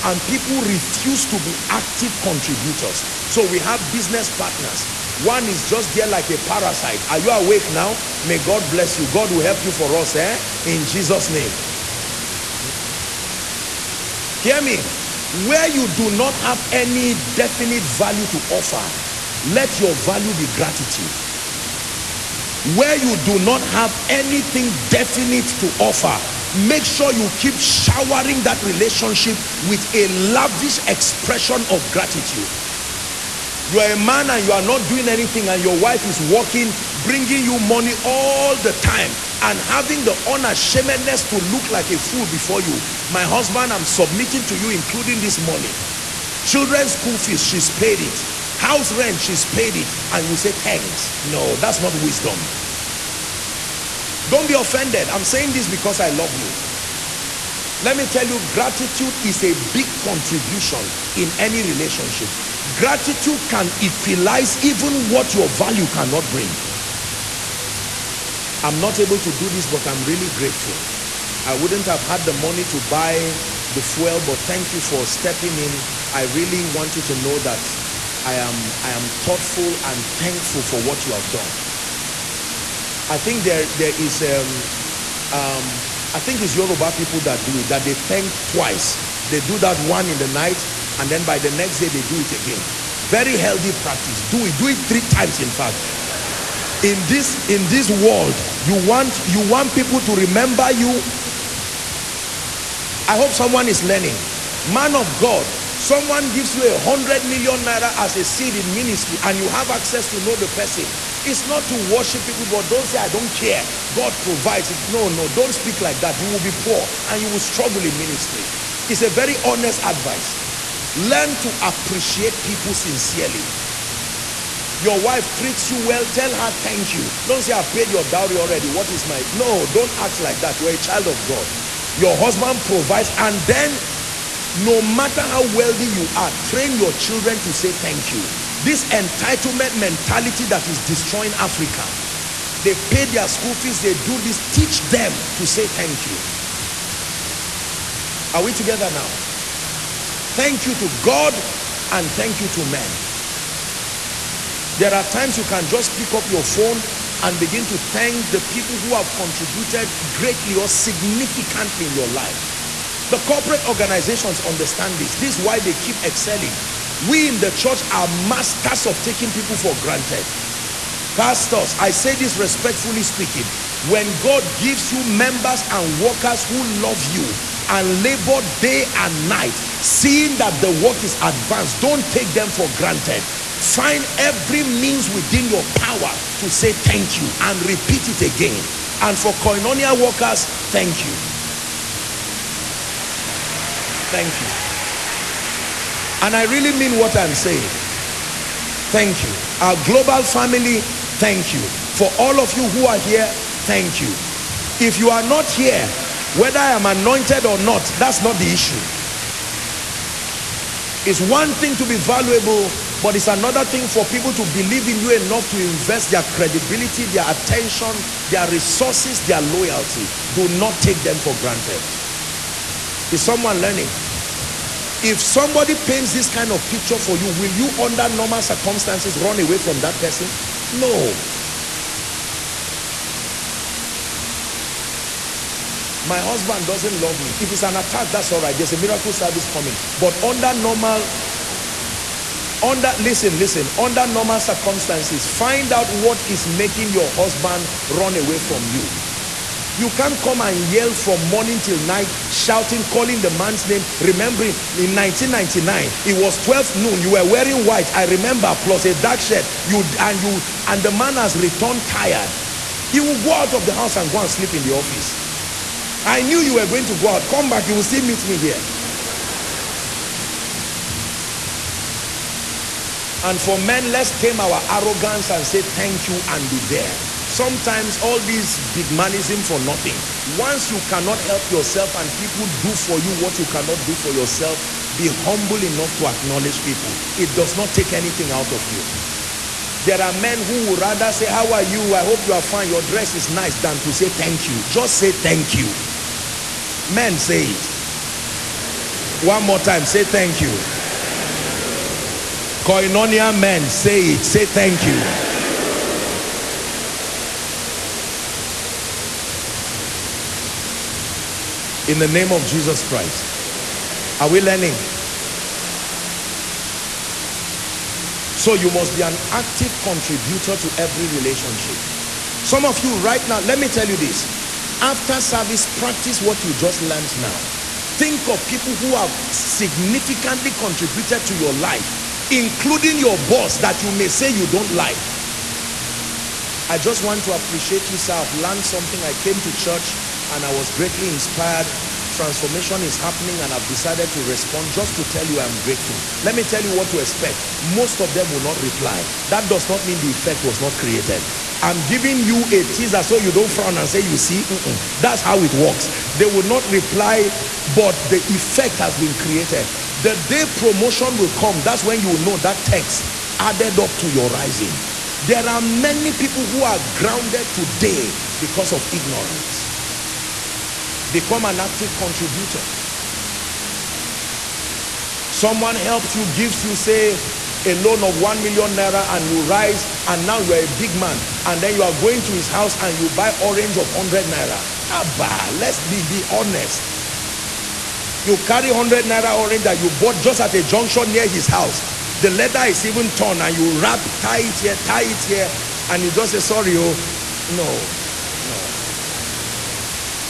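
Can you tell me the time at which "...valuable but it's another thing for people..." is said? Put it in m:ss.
3:31.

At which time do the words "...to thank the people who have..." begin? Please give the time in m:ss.
2:37.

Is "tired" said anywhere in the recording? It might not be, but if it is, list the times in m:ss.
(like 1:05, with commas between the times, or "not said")
4:21.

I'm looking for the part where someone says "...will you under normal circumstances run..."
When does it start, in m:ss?
3:47.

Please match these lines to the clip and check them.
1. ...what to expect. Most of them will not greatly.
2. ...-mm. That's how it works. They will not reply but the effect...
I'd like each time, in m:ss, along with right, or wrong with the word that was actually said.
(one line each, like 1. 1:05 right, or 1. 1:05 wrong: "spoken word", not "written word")
1. 5:46 wrong: "reply", not "greatly"
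2. 5:54 right.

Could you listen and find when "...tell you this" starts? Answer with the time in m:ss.
5:23.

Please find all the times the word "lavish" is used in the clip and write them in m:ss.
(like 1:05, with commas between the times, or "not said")
0:30.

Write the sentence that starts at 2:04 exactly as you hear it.
Your wife treats you well, tell her thank you.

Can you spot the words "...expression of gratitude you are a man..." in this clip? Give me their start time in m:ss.
0:30.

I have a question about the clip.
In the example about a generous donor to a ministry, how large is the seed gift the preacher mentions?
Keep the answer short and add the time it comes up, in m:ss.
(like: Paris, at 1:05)
100 million naira, at 1:46.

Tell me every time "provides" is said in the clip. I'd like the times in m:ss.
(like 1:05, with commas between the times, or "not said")
1:54, 2:12.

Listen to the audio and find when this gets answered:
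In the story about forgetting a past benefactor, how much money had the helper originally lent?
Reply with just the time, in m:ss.
6:18.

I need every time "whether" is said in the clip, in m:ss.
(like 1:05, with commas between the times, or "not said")
3:26.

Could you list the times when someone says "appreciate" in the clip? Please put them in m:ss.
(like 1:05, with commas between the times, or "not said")
2:01, 5:37.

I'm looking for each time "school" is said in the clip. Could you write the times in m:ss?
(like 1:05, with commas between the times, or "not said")
0:46, 2:23.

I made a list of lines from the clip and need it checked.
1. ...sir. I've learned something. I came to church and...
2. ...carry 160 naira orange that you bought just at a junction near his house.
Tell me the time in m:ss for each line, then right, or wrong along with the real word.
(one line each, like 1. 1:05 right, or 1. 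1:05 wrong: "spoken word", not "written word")
1. 5:37 right
2. 6:28 wrong: "100", not "160".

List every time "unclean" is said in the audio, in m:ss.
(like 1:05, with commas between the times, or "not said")
not said.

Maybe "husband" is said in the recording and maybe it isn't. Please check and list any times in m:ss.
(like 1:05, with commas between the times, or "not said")
0:43, 2:12, 3:56, 4:07.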